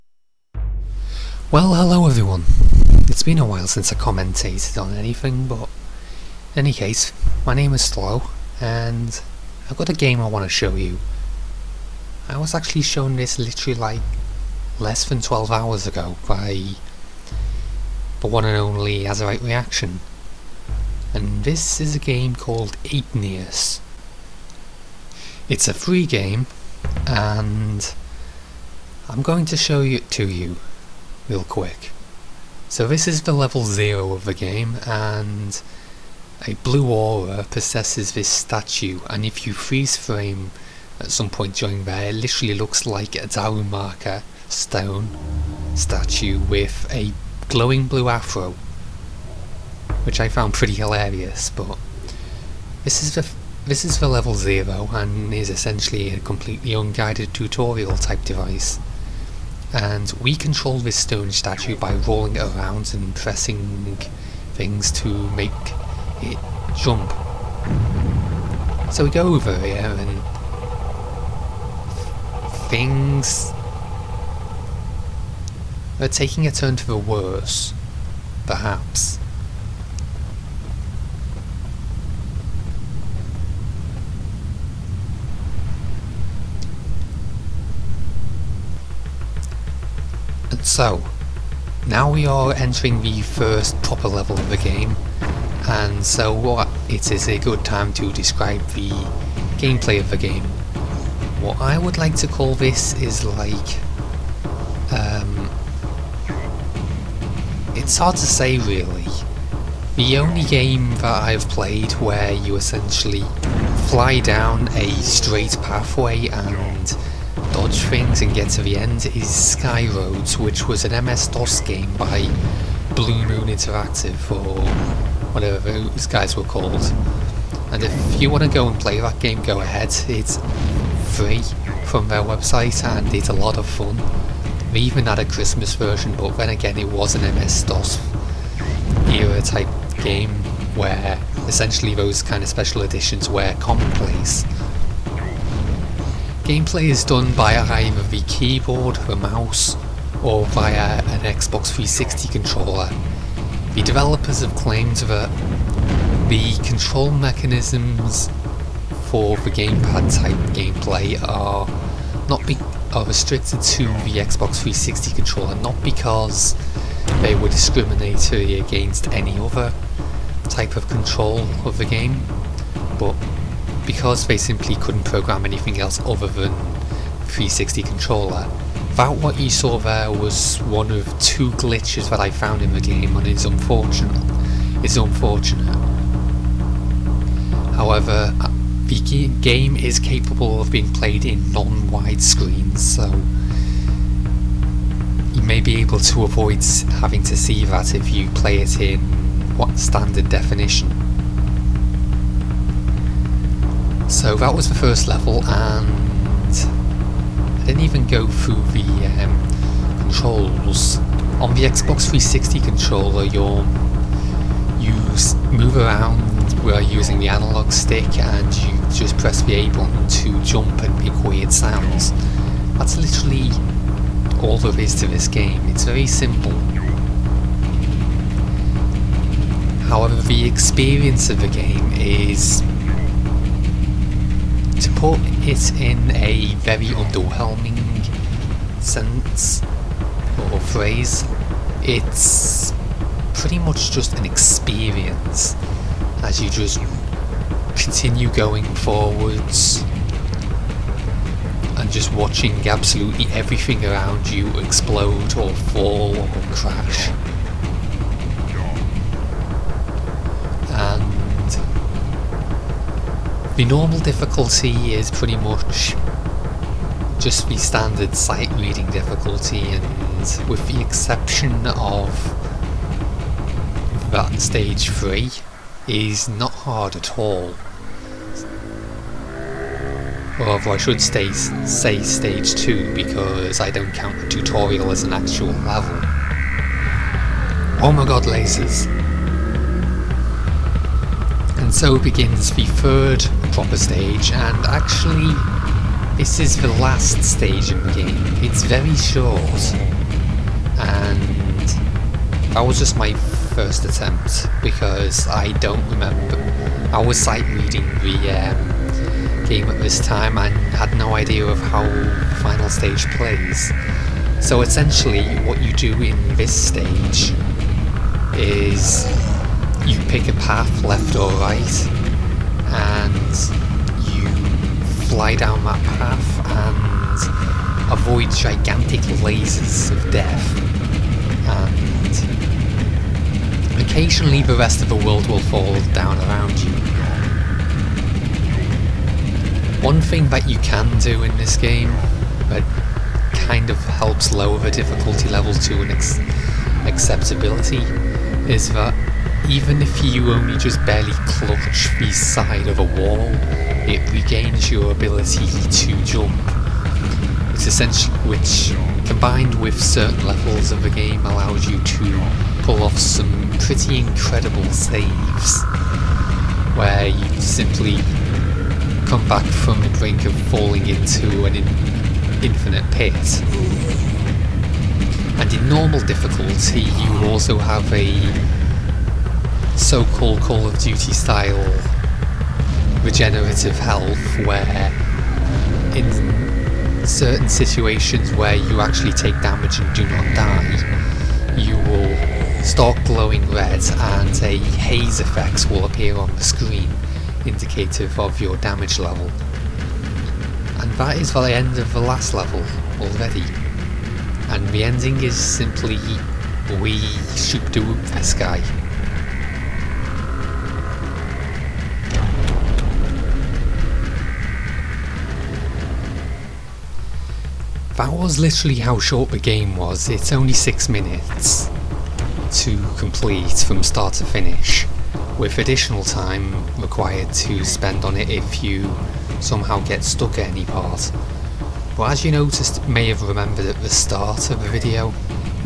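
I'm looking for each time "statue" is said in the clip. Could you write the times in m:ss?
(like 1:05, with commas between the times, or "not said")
0:38, 0:45, 1:01.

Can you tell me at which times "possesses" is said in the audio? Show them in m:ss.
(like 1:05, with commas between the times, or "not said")
0:37.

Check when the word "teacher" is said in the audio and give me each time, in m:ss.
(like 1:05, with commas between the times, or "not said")
not said.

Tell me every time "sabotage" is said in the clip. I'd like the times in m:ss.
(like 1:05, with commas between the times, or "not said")
not said.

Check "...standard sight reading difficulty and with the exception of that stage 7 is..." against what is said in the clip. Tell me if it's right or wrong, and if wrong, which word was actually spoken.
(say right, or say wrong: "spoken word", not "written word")
wrong: "3", not "7".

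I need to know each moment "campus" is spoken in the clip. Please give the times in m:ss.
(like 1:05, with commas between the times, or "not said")
not said.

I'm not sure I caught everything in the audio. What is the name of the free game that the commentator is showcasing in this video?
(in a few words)
Igneous.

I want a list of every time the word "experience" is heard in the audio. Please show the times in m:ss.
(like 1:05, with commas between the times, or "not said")
3:50, 4:04.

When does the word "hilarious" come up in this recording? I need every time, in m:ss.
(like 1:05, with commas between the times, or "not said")
0:50.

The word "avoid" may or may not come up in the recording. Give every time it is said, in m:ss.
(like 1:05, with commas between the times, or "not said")
3:16, 5:27.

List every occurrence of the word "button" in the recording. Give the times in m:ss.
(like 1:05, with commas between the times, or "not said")
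3:39.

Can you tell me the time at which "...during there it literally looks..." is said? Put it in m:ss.
0:41.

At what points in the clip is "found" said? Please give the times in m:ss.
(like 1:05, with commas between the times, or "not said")
0:50, 3:02.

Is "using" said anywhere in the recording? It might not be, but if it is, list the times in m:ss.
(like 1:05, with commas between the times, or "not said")
3:36.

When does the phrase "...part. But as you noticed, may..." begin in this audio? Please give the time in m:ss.
7:10.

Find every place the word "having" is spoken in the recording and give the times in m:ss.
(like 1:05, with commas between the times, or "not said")
3:17.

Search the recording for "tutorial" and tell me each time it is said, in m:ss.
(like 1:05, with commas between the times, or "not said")
0:57, 4:44.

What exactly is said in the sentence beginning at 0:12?
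I was actually shown this literally like less than 12 hours ago by the one and only As Right Reaction.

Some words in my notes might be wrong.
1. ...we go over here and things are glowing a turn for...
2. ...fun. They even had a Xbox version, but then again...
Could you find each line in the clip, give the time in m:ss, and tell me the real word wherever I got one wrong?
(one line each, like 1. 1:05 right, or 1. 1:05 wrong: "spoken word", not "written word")
1. 1:09 wrong: "taking", not "glowing"
2. 2:13 wrong: "Christmas", not "Xbox".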